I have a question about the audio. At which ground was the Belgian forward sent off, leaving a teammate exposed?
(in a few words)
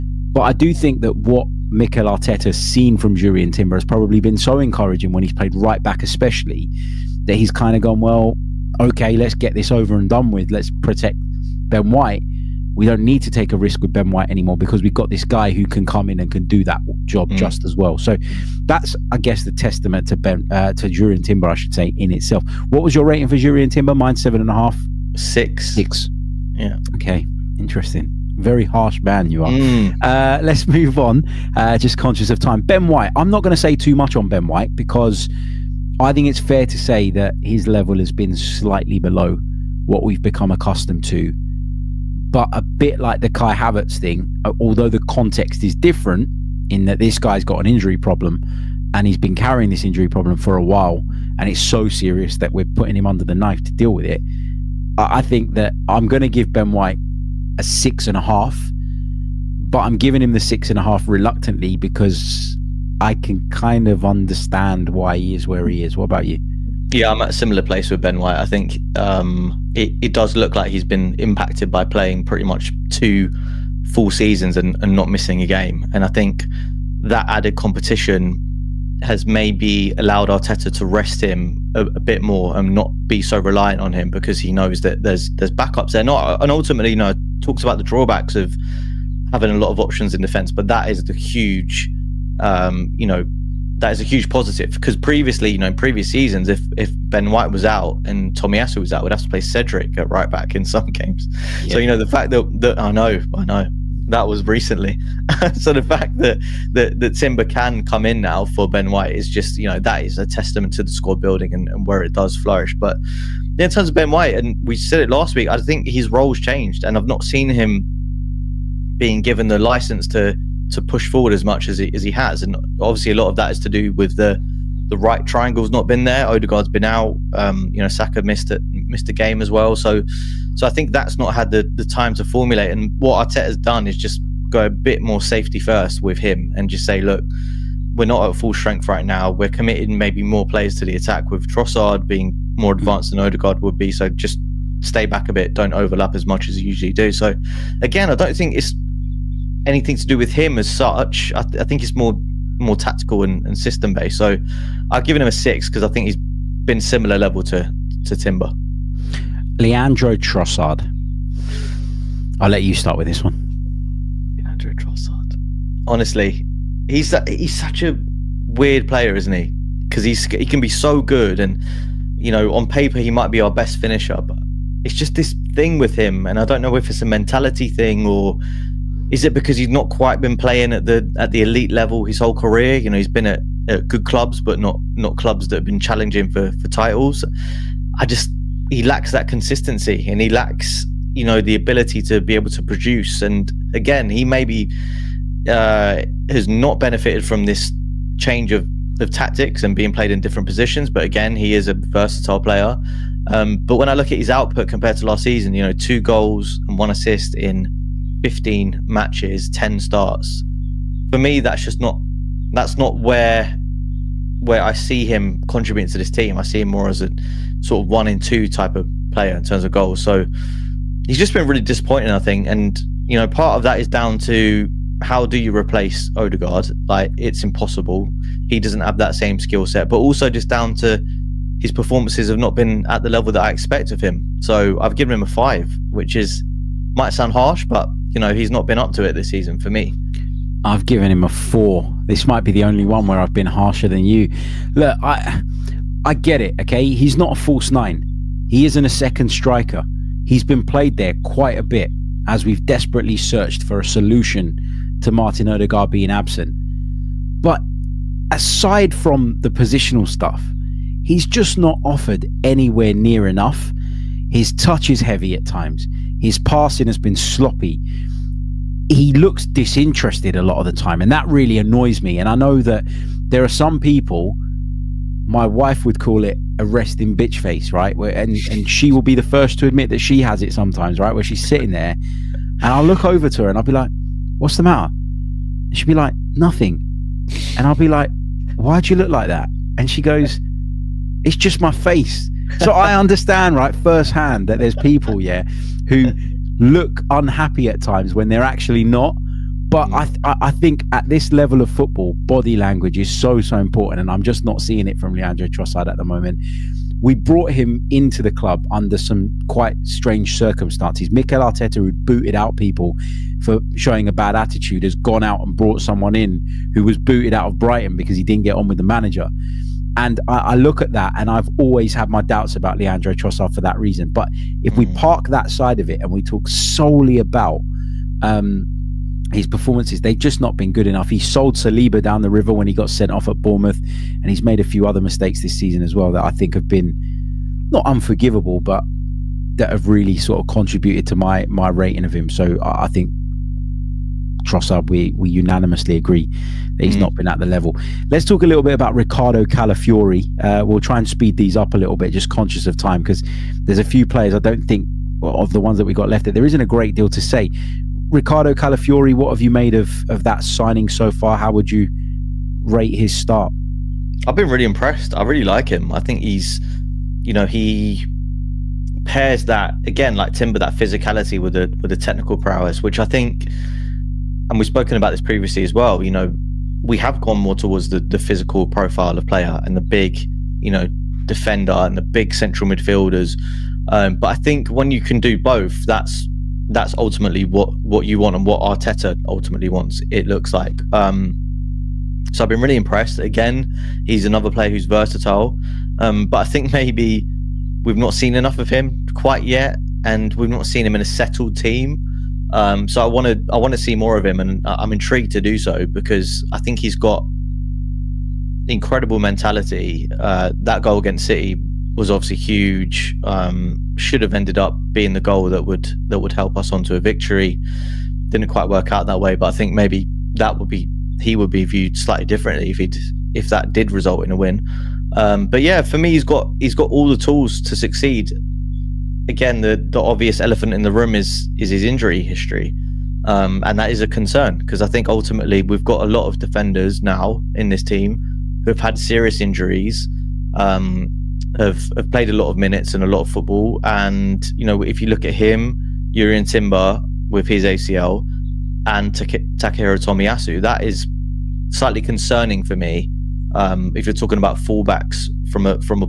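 Bournemouth.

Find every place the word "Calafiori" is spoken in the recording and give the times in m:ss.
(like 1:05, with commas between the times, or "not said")
5:49, 5:58.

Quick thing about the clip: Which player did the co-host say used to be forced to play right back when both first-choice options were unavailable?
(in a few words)
Cedric.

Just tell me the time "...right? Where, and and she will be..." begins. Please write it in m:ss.
4:37.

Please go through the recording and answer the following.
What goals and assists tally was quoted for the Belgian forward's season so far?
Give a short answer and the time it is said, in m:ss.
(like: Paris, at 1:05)
2 goals and 1 assist, at 3:25.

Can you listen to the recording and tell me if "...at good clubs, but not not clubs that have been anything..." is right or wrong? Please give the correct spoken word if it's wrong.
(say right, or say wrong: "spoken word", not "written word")
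wrong: "challenging", not "anything".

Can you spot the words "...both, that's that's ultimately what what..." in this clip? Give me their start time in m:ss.
6:25.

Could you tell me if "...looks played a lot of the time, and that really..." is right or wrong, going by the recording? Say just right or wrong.
wrong.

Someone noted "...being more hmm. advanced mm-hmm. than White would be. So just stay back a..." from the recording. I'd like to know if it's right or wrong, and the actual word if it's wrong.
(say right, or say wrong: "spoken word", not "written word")
wrong: "Odegaard", not "White".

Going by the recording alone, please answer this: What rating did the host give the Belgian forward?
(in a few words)
4.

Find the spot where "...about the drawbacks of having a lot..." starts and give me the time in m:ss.
1:27.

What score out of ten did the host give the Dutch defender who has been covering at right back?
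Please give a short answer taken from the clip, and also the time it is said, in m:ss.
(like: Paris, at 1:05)
7.5, at 0:24.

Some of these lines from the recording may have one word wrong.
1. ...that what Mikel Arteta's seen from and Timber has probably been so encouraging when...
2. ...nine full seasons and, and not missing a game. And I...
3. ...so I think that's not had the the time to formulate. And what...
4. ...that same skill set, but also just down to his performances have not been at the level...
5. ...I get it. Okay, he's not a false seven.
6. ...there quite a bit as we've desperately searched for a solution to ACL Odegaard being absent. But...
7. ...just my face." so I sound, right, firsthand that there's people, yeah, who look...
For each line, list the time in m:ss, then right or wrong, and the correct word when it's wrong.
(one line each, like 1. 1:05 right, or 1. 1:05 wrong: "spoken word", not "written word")
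1. 0:01 right
2. 1:12 wrong: "two", not "nine"
3. 2:10 right
4. 3:48 right
5. 4:06 wrong: "nine", not "seven"
6. 4:10 wrong: "Martin", not "ACL"
7. 4:51 wrong: "understand", not "sound".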